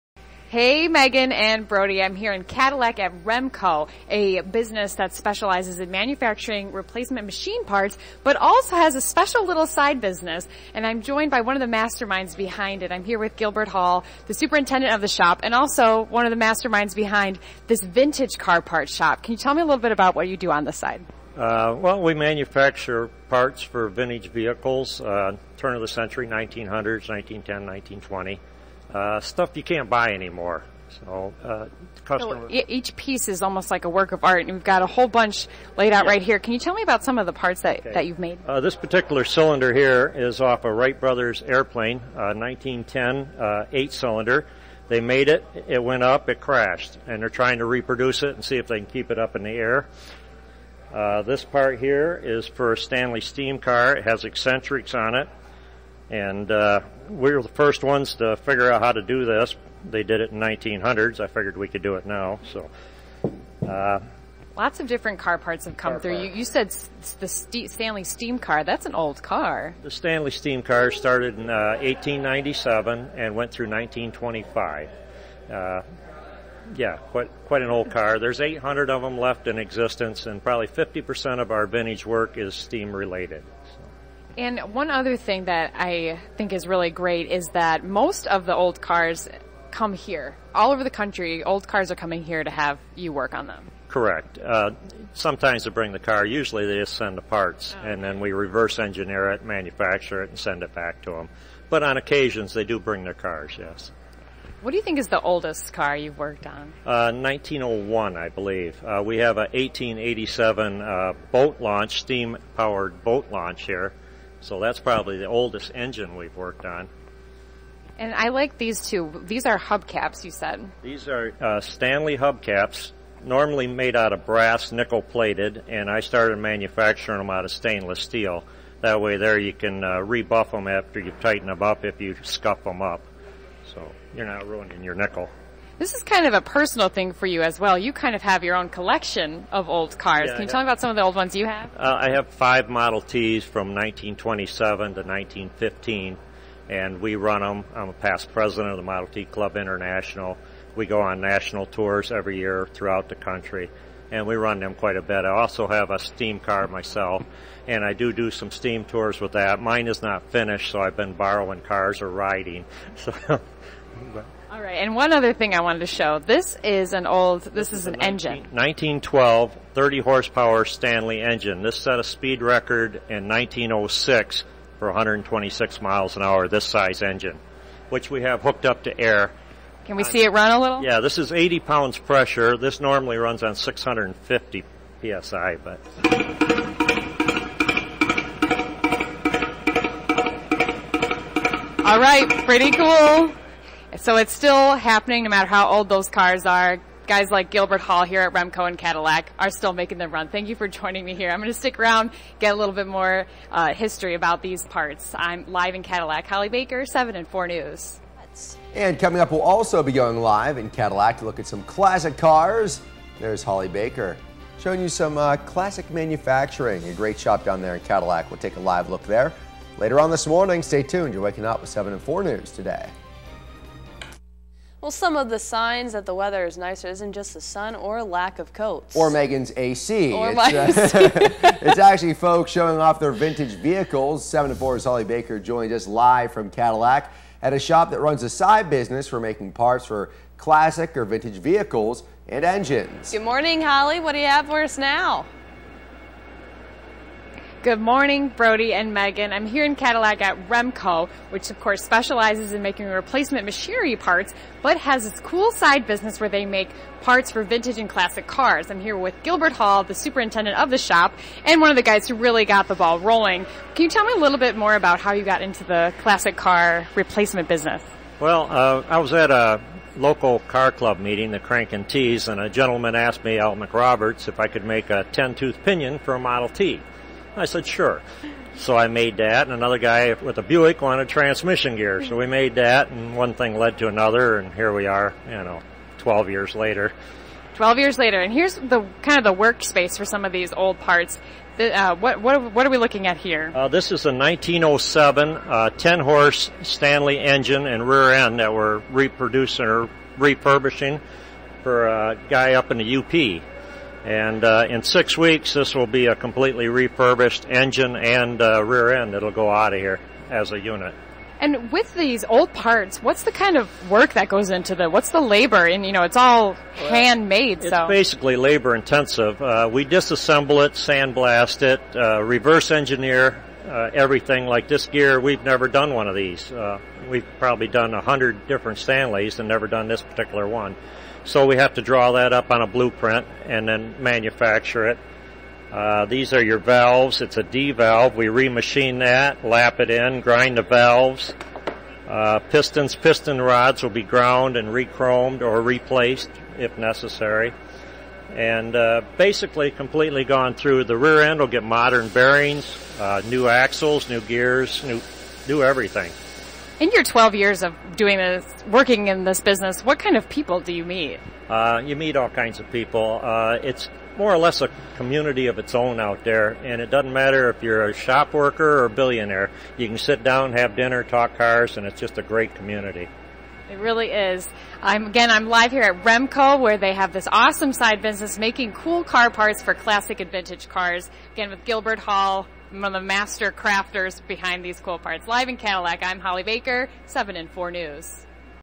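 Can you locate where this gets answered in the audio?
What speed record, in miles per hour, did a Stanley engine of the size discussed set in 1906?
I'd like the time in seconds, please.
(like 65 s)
174 s.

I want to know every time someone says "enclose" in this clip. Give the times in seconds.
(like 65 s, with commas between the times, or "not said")
not said.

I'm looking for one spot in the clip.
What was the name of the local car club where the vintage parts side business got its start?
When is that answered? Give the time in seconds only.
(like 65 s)
271 s.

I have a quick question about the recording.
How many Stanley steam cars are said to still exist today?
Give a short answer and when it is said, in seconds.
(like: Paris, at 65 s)
800, at 78 s.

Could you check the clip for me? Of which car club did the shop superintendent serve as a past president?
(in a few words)
Model T Club International.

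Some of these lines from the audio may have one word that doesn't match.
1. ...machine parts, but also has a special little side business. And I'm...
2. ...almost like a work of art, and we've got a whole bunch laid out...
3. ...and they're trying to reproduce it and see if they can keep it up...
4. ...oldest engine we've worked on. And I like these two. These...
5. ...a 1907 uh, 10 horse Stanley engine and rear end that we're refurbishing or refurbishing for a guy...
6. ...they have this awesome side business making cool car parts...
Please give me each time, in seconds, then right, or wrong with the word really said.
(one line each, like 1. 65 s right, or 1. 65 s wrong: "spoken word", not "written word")
1. 7 s right
2. 33 s right
3. 47 s right
4. 115 s right
5. 294 s wrong: "reproducing", not "refurbishing"
6. 376 s right.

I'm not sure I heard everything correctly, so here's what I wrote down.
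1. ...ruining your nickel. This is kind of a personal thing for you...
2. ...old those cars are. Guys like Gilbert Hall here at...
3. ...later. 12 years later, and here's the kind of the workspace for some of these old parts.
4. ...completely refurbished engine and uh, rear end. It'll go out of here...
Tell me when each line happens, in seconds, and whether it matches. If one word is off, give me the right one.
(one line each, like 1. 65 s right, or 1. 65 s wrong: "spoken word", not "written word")
1. 134 s right
2. 195 s right
3. 286 s right
4. 306 s right.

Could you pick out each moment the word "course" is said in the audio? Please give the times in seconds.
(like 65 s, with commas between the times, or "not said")
251 s.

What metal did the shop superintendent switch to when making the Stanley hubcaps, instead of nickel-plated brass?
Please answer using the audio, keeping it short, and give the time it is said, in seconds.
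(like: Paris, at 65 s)
stainless steel, at 127 s.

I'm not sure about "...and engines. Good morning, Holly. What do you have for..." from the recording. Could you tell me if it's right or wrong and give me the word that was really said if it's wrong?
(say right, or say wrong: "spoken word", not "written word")
right.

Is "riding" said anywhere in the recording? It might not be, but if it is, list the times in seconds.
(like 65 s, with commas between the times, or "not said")
162 s.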